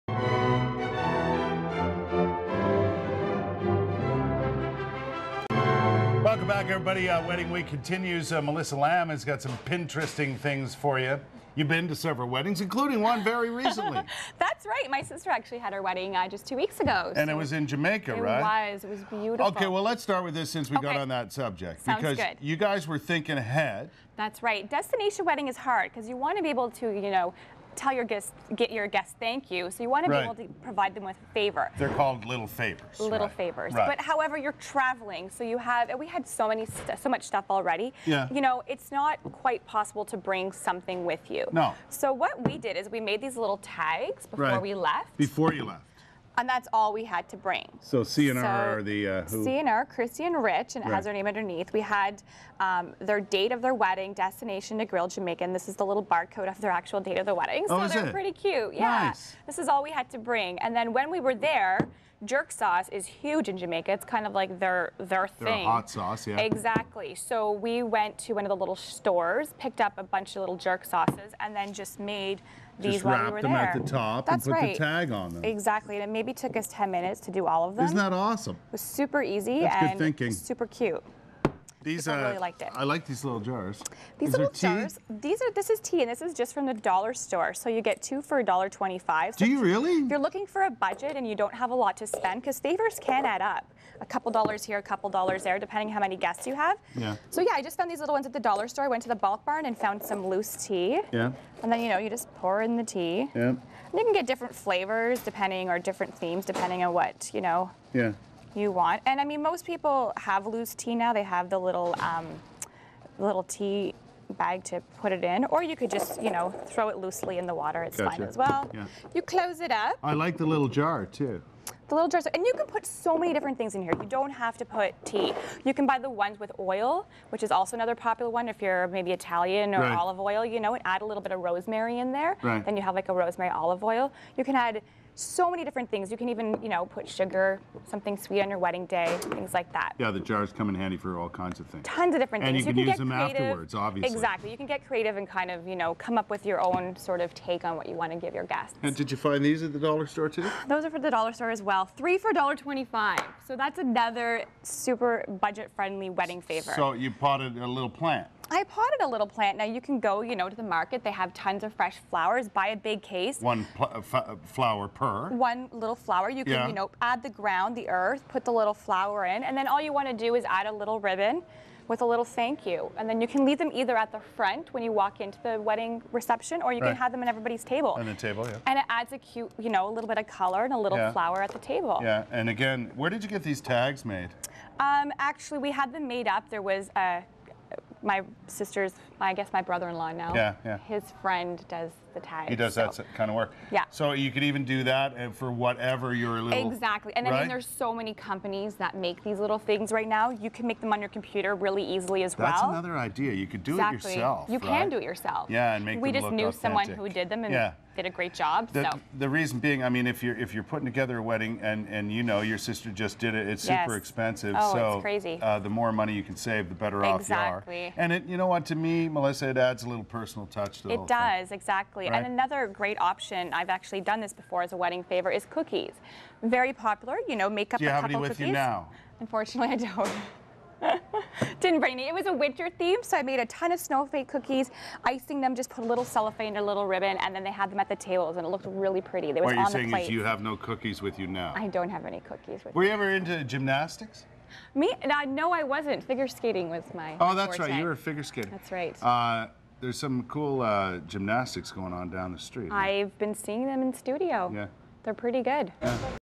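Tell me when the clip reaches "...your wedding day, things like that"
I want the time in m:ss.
2:18.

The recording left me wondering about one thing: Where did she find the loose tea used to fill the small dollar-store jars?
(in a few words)
Bulk Barn.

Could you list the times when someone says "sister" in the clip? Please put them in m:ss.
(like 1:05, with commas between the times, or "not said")
0:15, 3:08, 3:32.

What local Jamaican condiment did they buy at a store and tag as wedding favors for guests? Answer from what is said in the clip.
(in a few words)
Jerk sauce.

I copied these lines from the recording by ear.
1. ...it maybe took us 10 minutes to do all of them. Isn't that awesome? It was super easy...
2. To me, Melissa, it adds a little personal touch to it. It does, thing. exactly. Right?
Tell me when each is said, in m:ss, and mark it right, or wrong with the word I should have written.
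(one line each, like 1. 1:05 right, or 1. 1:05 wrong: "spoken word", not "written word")
1. 1:16 right
2. 3:38 right.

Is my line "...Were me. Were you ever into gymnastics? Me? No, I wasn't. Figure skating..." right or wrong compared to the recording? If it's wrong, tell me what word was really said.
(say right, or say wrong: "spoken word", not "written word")
right.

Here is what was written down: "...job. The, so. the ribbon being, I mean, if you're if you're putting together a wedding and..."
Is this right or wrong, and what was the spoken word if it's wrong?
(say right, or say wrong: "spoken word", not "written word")
wrong: "reason", not "ribbon".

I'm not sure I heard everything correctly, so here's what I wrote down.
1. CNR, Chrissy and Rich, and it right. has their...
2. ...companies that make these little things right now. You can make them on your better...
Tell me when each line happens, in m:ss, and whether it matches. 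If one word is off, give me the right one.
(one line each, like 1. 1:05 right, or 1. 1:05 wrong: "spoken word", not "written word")
1. 0:49 right
2. 3:18 wrong: "computer", not "better".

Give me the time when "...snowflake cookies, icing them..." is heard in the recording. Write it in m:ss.
3:53.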